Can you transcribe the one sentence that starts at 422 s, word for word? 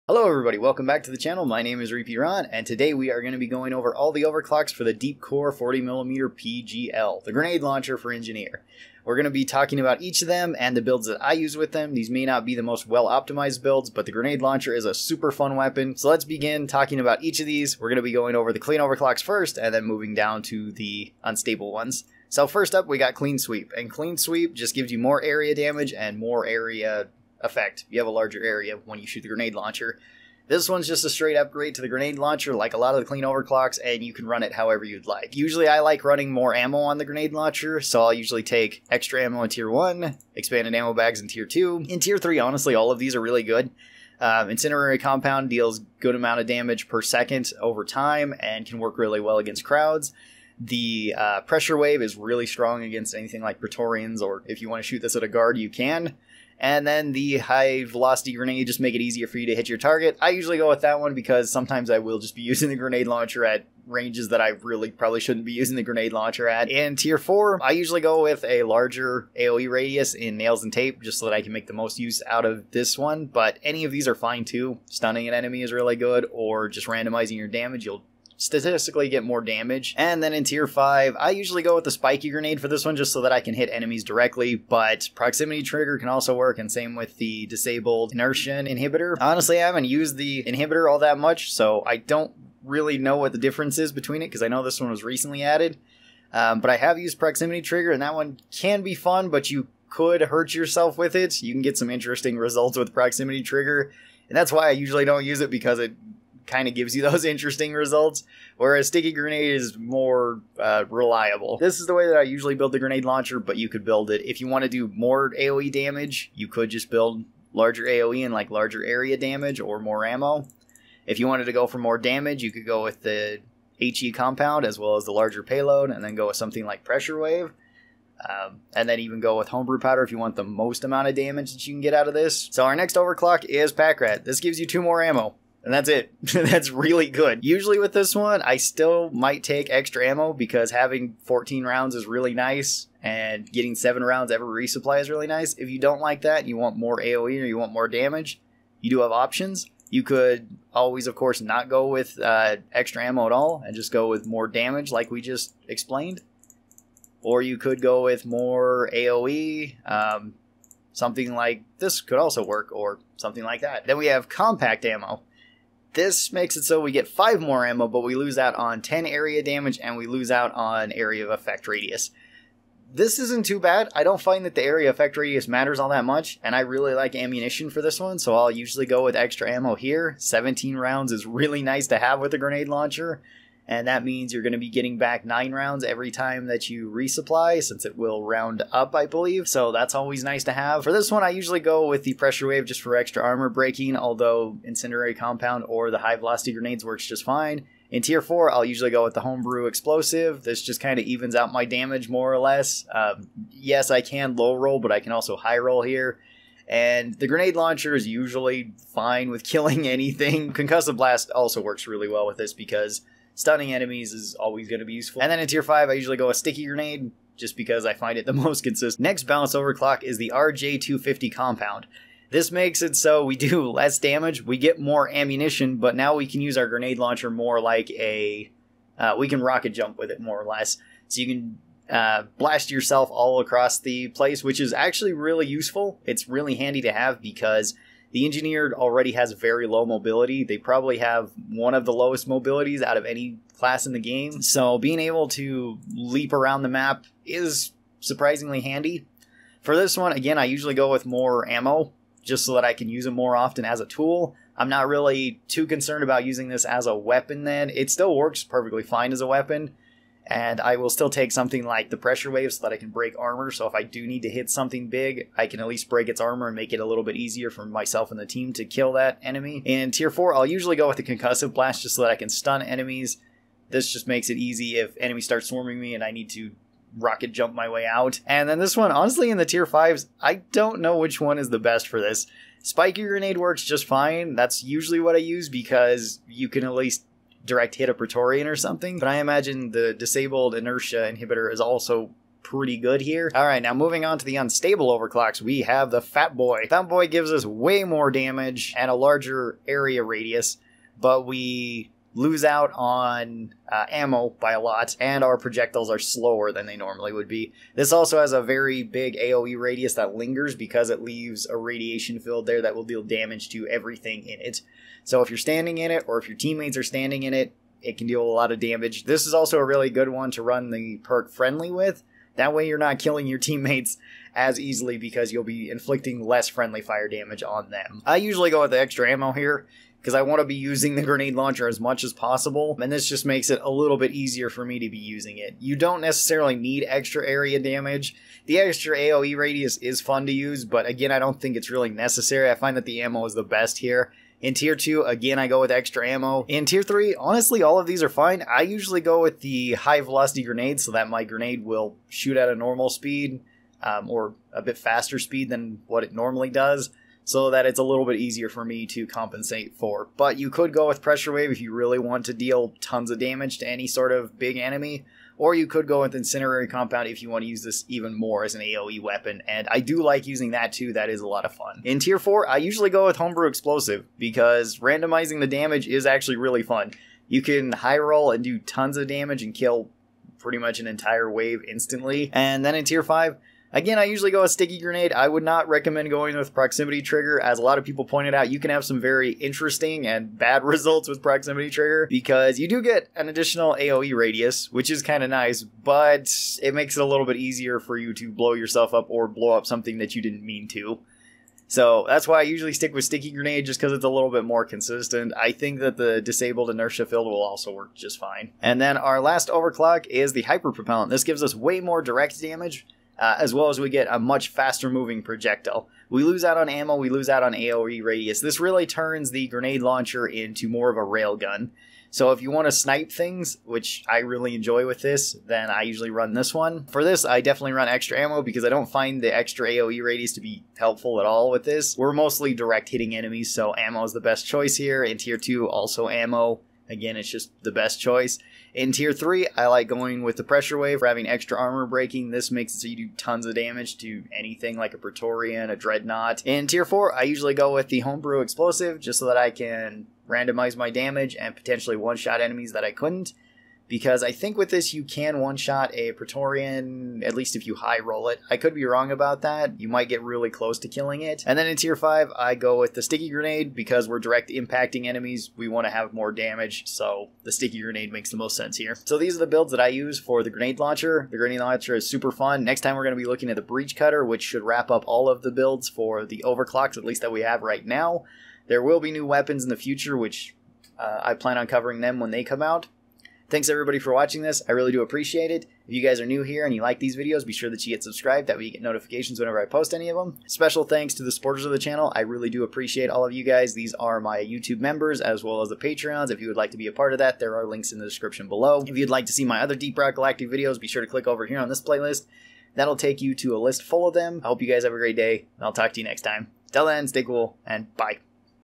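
So if you want to snipe things, which I really enjoy with this, then I usually run this one.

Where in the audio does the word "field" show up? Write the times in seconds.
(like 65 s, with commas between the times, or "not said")
312 s, 407 s.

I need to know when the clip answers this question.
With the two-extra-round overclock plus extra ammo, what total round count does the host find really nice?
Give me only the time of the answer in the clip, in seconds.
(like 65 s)
141 s.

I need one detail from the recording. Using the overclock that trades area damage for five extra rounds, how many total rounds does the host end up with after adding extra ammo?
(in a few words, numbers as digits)
17.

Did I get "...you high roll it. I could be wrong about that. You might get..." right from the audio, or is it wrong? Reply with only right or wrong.
right.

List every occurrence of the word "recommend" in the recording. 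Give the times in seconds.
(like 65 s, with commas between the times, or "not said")
385 s.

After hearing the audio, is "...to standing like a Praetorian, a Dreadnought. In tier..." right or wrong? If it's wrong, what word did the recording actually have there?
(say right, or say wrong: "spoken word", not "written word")
wrong: "anything", not "standing".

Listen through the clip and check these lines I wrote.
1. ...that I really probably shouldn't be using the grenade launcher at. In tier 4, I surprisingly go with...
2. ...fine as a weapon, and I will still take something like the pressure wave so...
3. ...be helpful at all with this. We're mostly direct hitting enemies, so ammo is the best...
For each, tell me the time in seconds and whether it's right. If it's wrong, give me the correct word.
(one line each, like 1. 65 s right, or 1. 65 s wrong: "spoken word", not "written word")
1. 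64 s wrong: "usually", not "surprisingly"
2. 258 s right
3. 430 s right.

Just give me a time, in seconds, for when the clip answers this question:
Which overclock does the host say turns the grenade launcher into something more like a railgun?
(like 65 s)
410 s.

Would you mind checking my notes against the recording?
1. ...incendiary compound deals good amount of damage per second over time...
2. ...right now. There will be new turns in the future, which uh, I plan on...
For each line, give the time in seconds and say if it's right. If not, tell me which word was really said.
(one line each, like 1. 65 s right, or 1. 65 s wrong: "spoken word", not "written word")
1. 44 s right
2. 477 s wrong: "weapons", not "turns".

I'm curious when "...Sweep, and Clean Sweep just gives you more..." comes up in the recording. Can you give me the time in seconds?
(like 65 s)
23 s.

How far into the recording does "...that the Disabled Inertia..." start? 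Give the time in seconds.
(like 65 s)
405 s.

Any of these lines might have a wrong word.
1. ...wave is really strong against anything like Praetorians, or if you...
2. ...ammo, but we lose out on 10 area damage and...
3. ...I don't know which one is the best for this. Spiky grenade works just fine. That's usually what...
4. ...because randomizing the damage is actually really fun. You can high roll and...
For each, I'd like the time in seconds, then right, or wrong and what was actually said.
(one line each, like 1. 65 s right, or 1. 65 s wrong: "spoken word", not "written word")
1. 51 s right
2. 167 s right
3. 280 s right
4. 374 s right.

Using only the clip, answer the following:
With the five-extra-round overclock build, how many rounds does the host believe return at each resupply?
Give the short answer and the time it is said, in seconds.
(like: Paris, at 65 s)
9, at 185 s.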